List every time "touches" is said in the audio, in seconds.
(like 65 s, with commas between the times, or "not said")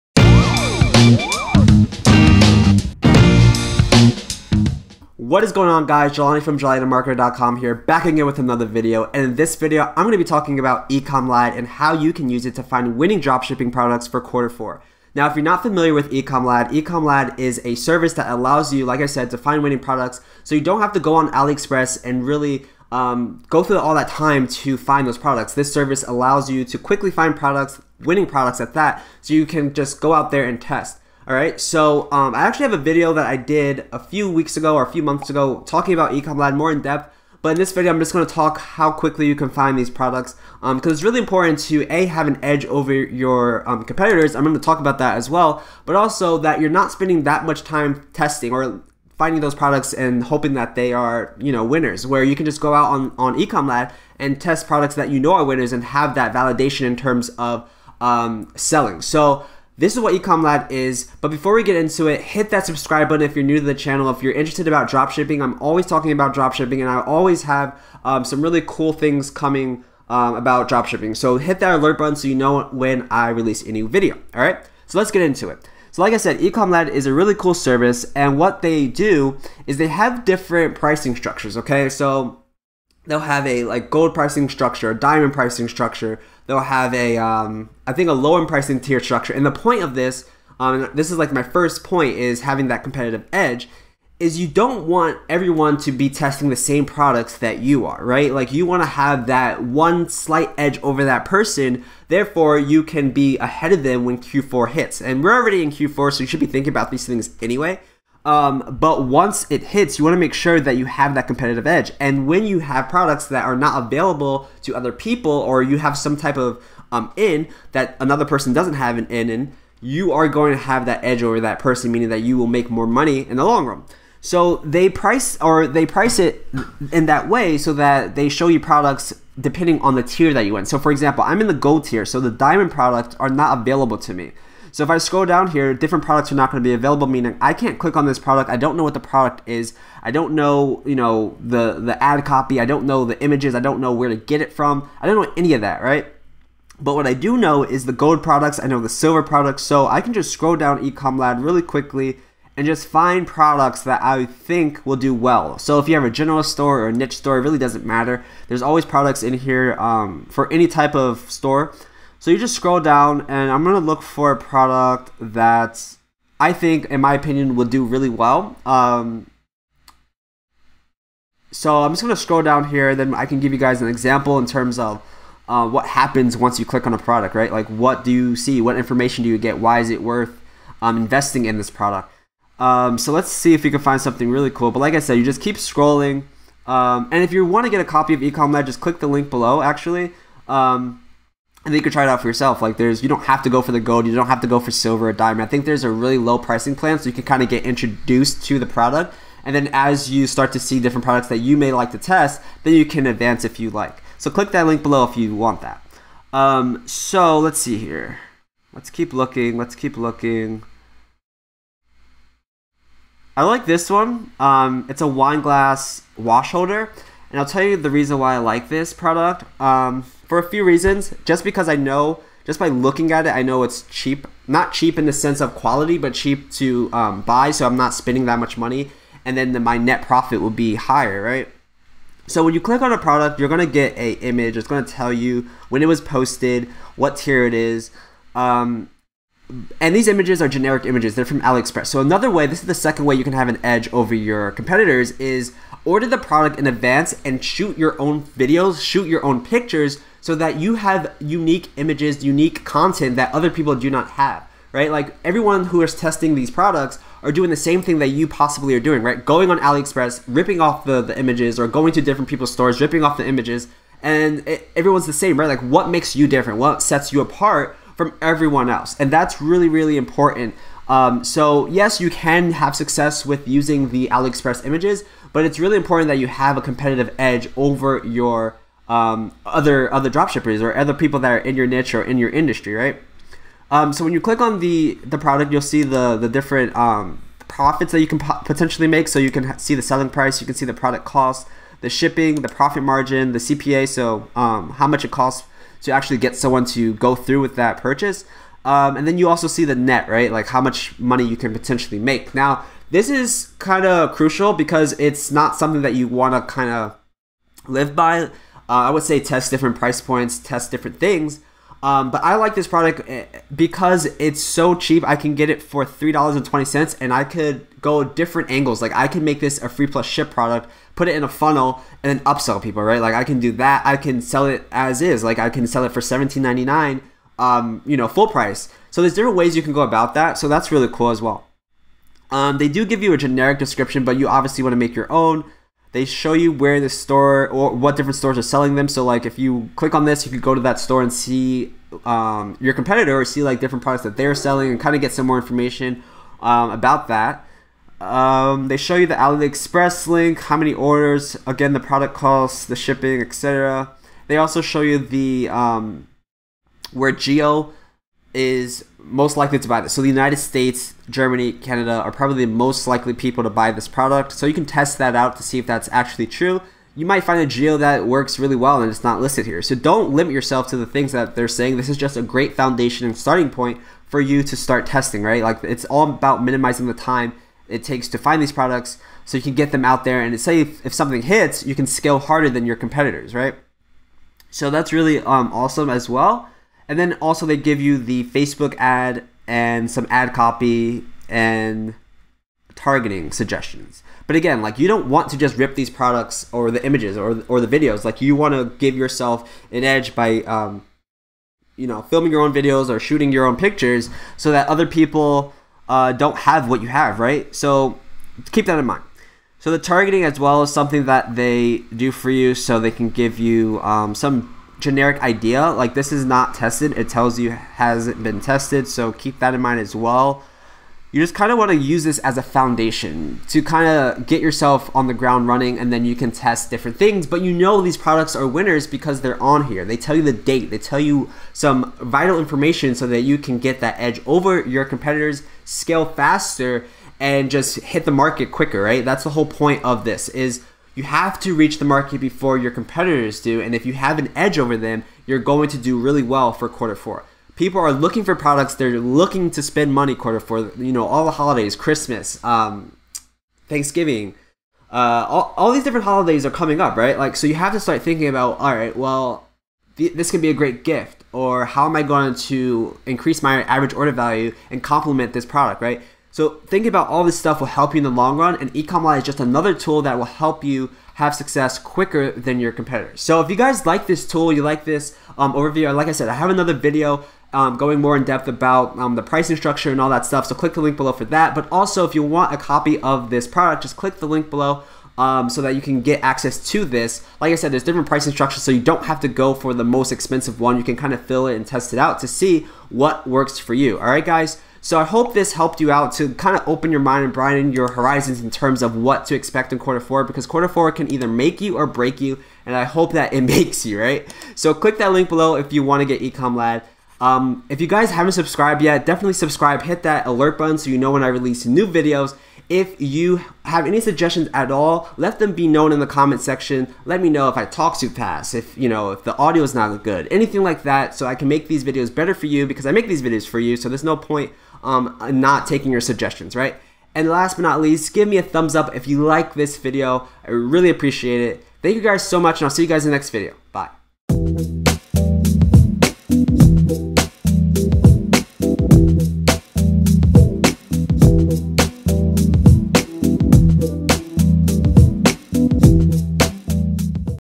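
not said.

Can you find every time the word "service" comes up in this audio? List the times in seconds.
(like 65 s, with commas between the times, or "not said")
17 s, 25 s, 77 s.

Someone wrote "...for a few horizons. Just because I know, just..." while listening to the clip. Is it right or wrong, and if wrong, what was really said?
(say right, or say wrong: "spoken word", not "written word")
wrong: "reasons", not "horizons".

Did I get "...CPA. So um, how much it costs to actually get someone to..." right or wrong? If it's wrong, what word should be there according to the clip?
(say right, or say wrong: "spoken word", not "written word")
right.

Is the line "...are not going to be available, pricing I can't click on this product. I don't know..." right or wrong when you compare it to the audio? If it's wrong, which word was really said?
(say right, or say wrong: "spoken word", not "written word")
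wrong: "meaning", not "pricing".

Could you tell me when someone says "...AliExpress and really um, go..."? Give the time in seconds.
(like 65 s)
21 s.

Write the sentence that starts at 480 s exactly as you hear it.
So click the link below for that.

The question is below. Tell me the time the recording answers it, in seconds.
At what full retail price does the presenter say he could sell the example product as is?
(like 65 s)
326 s.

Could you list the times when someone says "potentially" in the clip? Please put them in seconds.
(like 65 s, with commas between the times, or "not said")
288 s, 301 s.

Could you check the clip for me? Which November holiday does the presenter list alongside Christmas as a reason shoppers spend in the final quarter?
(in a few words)
Thanksgiving.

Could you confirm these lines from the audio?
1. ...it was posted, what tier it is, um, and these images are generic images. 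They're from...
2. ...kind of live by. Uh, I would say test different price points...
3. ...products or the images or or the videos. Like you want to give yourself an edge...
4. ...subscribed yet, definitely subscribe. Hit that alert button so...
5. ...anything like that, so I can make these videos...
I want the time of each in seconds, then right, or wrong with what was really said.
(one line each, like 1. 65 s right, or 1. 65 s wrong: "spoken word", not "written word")
1. 235 s right
2. 306 s right
3. 395 s right
4. 508 s right
5. 520 s right.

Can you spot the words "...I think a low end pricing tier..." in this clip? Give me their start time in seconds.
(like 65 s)
87 s.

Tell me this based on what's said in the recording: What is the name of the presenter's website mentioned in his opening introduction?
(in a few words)
JelaniTheMarketer.com.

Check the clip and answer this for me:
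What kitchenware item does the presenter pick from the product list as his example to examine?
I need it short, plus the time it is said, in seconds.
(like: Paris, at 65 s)
Wine glass wash holder, at 215 s.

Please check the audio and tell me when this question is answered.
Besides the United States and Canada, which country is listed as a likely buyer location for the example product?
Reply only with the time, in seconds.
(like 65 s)
361 s.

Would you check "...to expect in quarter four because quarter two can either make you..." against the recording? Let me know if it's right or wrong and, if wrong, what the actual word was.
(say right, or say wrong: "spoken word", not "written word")
wrong: "four", not "two".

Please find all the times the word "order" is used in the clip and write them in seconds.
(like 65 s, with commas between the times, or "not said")
245 s, 350 s, 463 s.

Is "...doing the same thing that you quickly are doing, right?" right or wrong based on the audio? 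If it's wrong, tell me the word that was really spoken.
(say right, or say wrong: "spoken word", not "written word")
wrong: "possibly", not "quickly".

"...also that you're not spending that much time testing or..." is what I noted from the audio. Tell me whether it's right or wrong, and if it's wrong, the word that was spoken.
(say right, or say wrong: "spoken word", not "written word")
right.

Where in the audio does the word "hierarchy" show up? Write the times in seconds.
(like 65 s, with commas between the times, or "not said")
not said.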